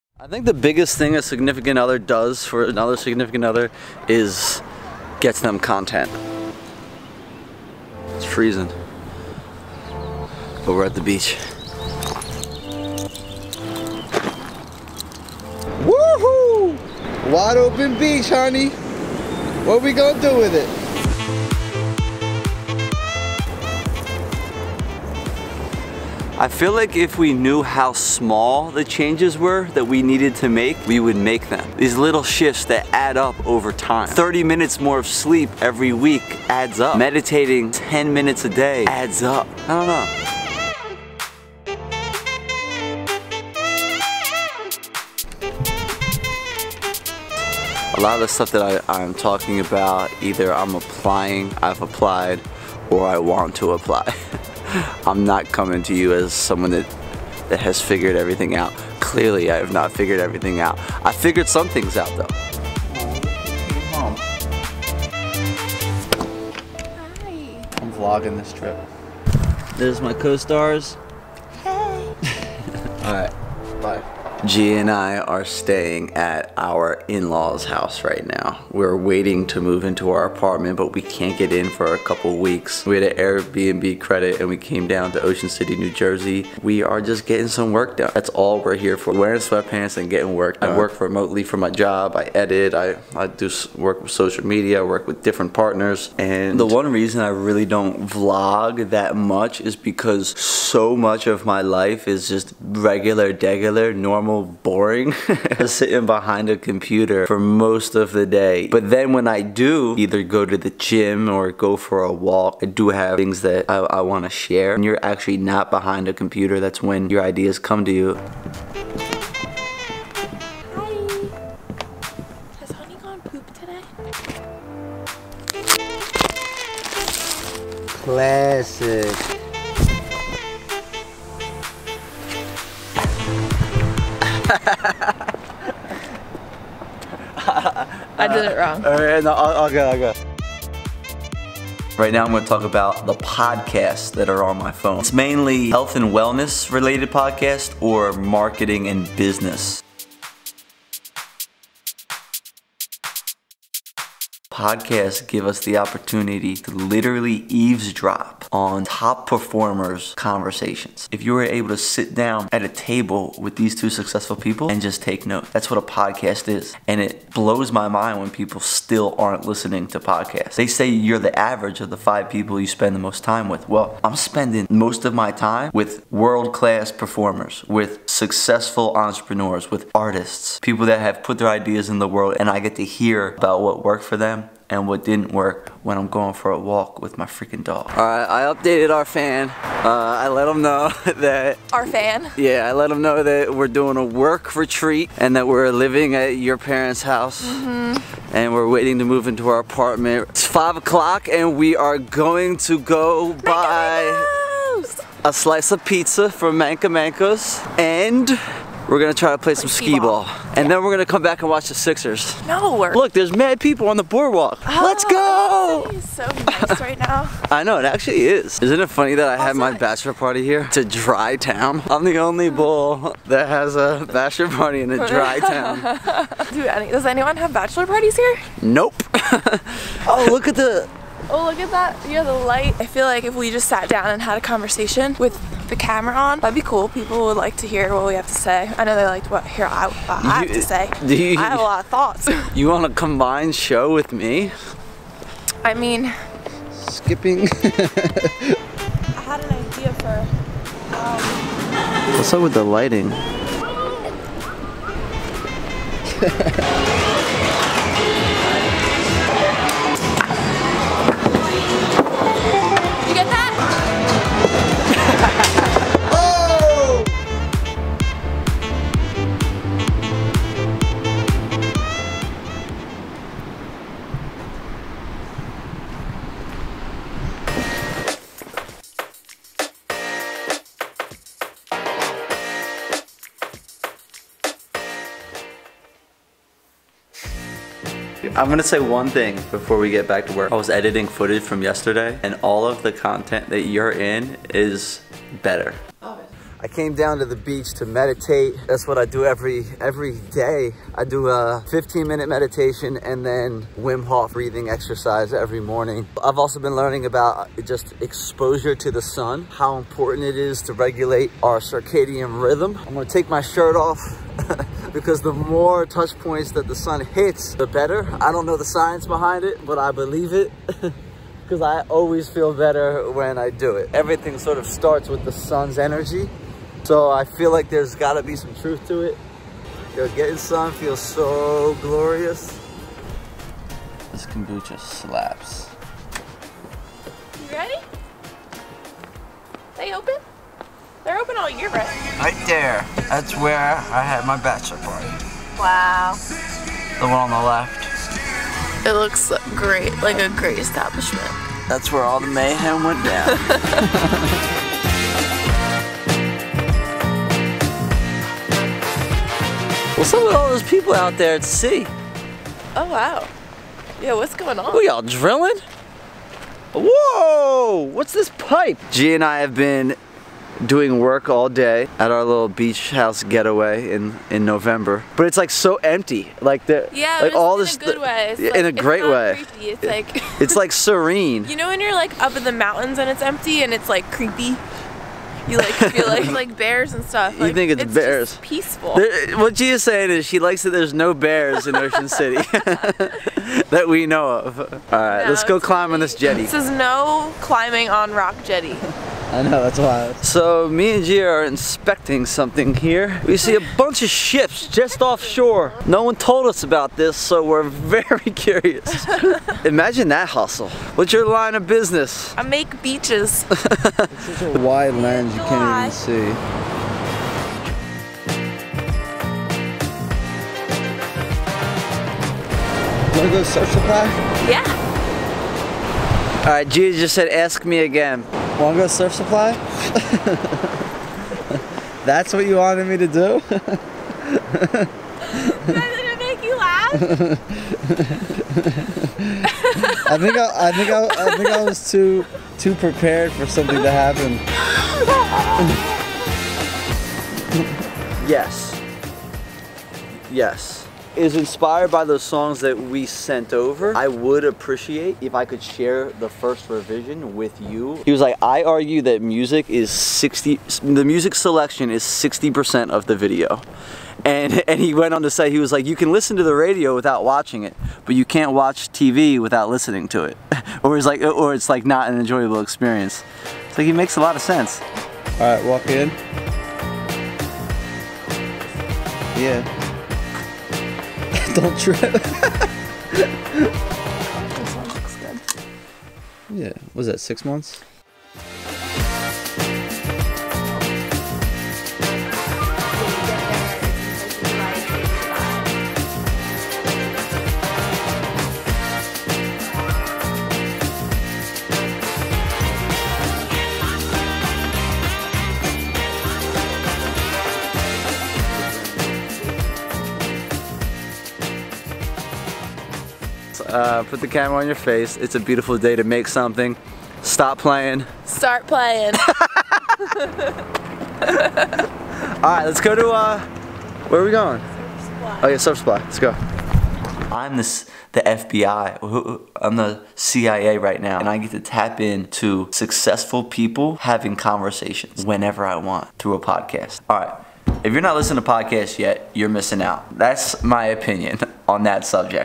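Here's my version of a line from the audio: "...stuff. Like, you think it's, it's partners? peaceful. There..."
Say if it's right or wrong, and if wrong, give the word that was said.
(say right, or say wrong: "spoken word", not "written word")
wrong: "bears", not "partners".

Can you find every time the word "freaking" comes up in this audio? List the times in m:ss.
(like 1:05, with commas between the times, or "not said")
3:07.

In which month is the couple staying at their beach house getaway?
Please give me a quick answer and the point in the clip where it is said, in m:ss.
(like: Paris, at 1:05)
November, at 6:14.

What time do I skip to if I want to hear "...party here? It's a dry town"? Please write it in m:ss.
3:40.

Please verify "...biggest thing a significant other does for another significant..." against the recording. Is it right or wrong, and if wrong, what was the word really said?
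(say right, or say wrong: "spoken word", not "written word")
right.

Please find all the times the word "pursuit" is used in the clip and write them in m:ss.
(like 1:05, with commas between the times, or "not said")
not said.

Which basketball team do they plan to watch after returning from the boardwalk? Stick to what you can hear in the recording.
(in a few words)
Sixers.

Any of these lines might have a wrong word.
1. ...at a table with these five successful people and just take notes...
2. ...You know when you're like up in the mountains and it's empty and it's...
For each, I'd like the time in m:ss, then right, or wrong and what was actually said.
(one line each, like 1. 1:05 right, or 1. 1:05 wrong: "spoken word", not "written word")
1. 2:42 wrong: "two", not "five"
2. 6:21 right.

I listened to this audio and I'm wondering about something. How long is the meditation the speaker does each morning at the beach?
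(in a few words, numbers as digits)
15 minutes.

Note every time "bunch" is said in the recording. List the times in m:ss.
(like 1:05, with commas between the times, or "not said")
6:43.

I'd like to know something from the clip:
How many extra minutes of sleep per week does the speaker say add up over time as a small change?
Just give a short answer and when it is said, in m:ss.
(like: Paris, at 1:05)
30, at 0:34.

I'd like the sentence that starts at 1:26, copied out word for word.
We are just getting some work done.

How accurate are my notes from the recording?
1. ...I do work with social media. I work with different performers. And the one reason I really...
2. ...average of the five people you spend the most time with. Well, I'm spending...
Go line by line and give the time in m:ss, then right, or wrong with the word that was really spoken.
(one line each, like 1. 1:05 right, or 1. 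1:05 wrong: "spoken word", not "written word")
1. 1:33 wrong: "partners", not "performers"
2. 2:51 right.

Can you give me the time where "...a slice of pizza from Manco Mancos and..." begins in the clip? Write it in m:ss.
3:25.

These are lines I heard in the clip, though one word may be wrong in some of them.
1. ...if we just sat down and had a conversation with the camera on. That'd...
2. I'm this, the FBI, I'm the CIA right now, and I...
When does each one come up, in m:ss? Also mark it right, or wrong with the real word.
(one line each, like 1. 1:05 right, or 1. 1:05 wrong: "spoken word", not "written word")
1. 3:53 right
2. 8:47 right.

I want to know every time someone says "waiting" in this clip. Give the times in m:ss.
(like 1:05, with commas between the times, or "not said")
1:18, 3:18.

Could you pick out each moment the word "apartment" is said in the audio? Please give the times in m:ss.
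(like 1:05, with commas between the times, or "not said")
1:20, 3:19.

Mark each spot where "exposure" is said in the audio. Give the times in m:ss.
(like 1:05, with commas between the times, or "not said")
5:07.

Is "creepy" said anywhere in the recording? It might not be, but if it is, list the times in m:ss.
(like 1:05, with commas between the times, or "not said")
6:19, 6:24.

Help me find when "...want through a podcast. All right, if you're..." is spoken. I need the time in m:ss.
8:55.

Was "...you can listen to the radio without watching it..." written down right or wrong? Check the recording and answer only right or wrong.
right.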